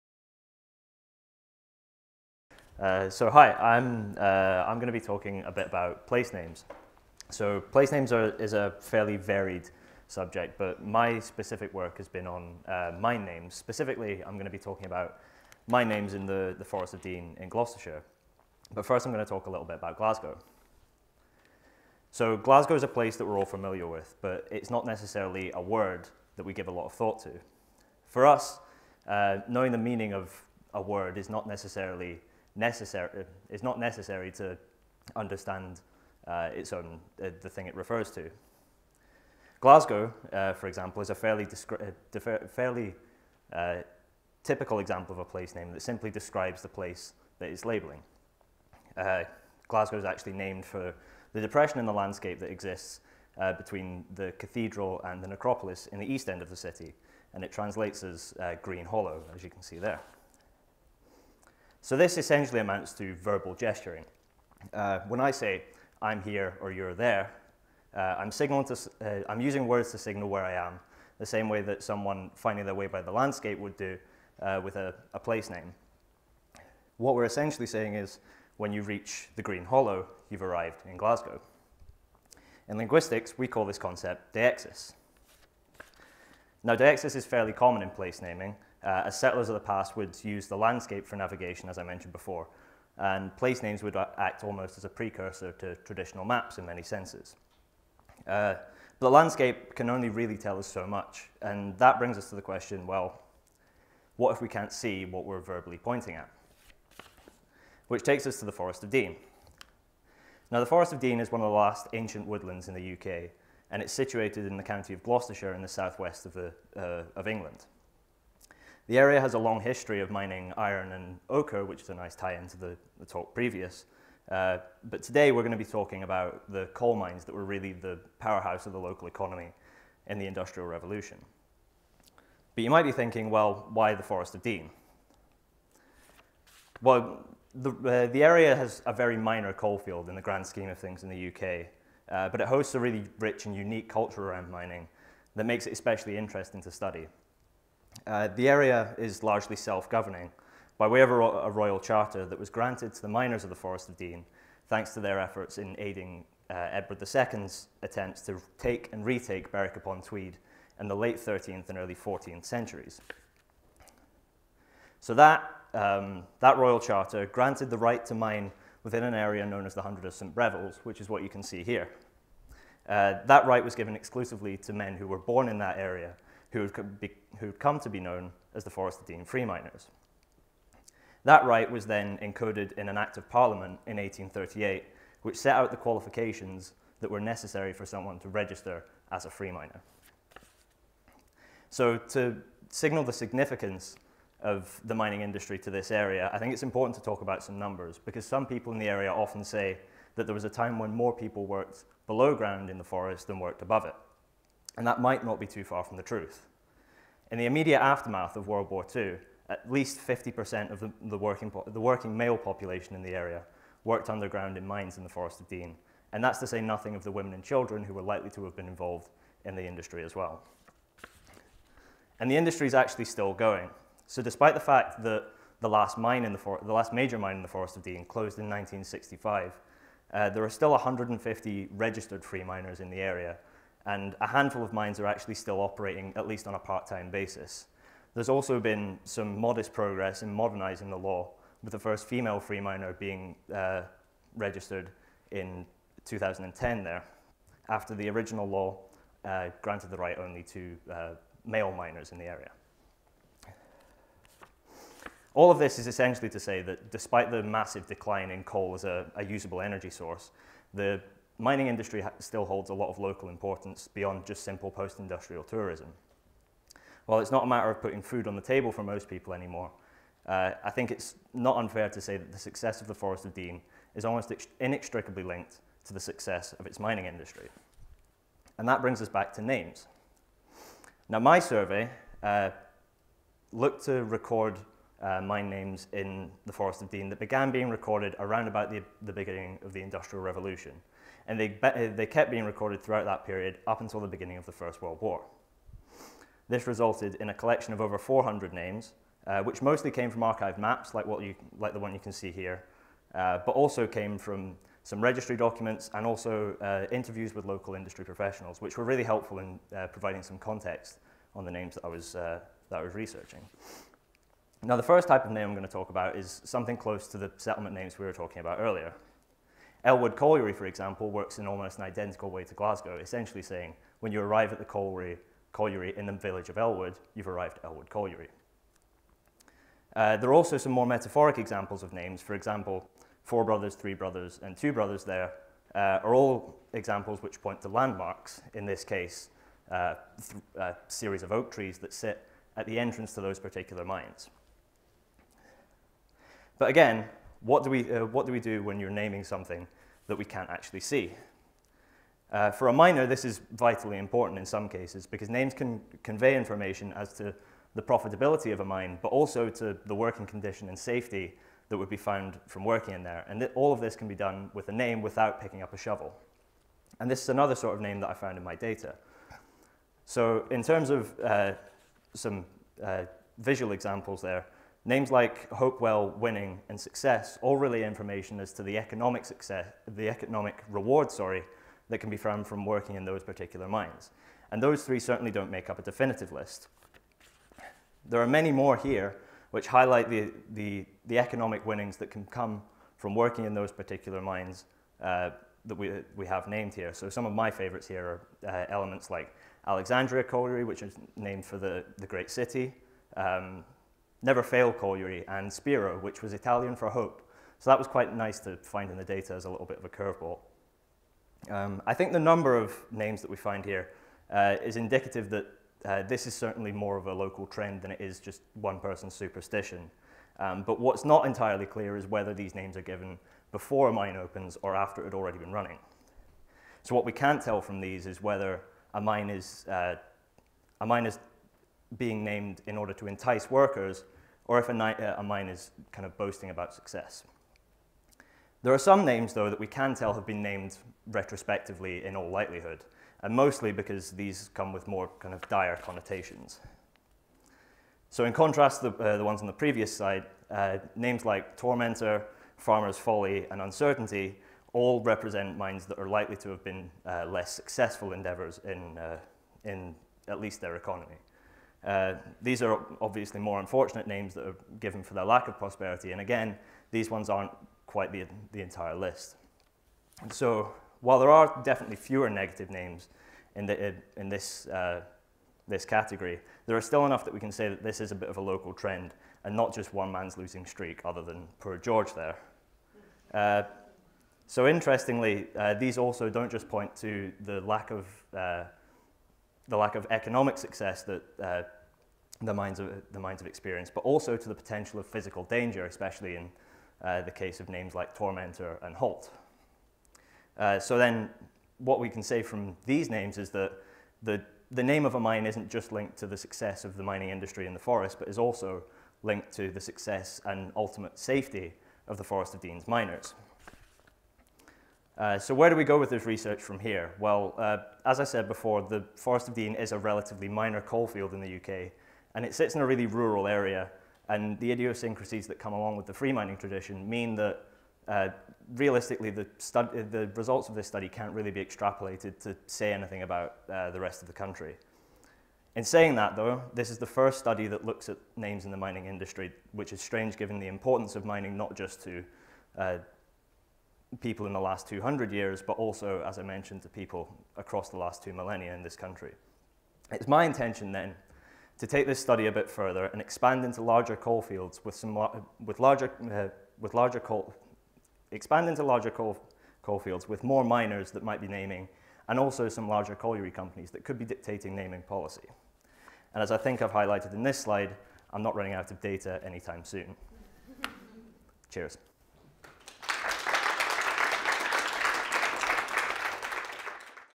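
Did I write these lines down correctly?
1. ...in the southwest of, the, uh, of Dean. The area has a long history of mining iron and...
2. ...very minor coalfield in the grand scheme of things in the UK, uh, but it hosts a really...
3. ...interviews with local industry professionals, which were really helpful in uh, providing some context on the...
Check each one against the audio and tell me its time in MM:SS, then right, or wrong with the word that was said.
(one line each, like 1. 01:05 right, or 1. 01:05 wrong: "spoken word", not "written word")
1. 01:55 wrong: "England", not "Dean"
2. 02:18 right
3. 05:06 right.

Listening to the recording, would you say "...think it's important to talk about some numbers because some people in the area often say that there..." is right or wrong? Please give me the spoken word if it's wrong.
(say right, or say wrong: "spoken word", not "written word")
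right.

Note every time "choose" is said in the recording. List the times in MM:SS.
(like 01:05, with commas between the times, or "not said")
not said.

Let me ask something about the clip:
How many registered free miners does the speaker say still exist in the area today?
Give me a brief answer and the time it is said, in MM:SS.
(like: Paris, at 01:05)
150, at 03:50.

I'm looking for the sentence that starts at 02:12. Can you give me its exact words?
But you might be thinking, well, why the Forest of Dean?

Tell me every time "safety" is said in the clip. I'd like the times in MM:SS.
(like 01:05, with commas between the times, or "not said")
06:00, 08:31.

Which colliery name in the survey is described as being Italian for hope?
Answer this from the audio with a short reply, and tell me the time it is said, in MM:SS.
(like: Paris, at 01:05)
Spiro, at 06:45.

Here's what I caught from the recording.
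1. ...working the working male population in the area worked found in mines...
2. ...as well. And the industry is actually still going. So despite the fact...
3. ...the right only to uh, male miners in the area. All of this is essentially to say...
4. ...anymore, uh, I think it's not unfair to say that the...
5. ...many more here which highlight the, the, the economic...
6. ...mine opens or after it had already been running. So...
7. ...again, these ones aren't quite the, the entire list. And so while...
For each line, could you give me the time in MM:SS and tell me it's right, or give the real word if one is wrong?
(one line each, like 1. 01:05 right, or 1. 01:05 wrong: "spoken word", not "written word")
1. 03:31 wrong: "underground", not "found"
2. 03:40 right
3. 04:09 right
4. 04:29 right
5. 06:28 right
6. 07:03 right
7. 07:46 right.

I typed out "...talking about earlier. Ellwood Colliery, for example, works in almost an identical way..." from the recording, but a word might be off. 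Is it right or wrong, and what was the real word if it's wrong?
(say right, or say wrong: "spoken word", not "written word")
right.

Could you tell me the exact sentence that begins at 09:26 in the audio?
And as I think I've highlighted in this slide, I'm not running out of data anytime soon.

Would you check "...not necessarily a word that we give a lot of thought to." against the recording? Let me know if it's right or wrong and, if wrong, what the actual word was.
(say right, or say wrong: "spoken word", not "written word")
right.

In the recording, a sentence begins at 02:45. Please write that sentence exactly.
So that, um, that royal charter granted the right to mine within an area known as the Hundred of St.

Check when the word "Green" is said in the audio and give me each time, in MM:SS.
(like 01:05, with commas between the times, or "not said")
00:58, 01:19.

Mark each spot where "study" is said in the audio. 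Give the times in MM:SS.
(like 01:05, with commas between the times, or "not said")
02:26, 08:50, 08:57, 09:12.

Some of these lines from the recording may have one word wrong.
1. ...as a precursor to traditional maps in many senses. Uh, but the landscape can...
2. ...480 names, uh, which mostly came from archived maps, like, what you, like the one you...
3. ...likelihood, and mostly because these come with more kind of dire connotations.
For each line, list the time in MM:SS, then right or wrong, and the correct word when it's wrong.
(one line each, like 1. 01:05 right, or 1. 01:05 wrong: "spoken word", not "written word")
1. 01:34 right
2. 04:57 wrong: "400", not "480"
3. 07:22 right.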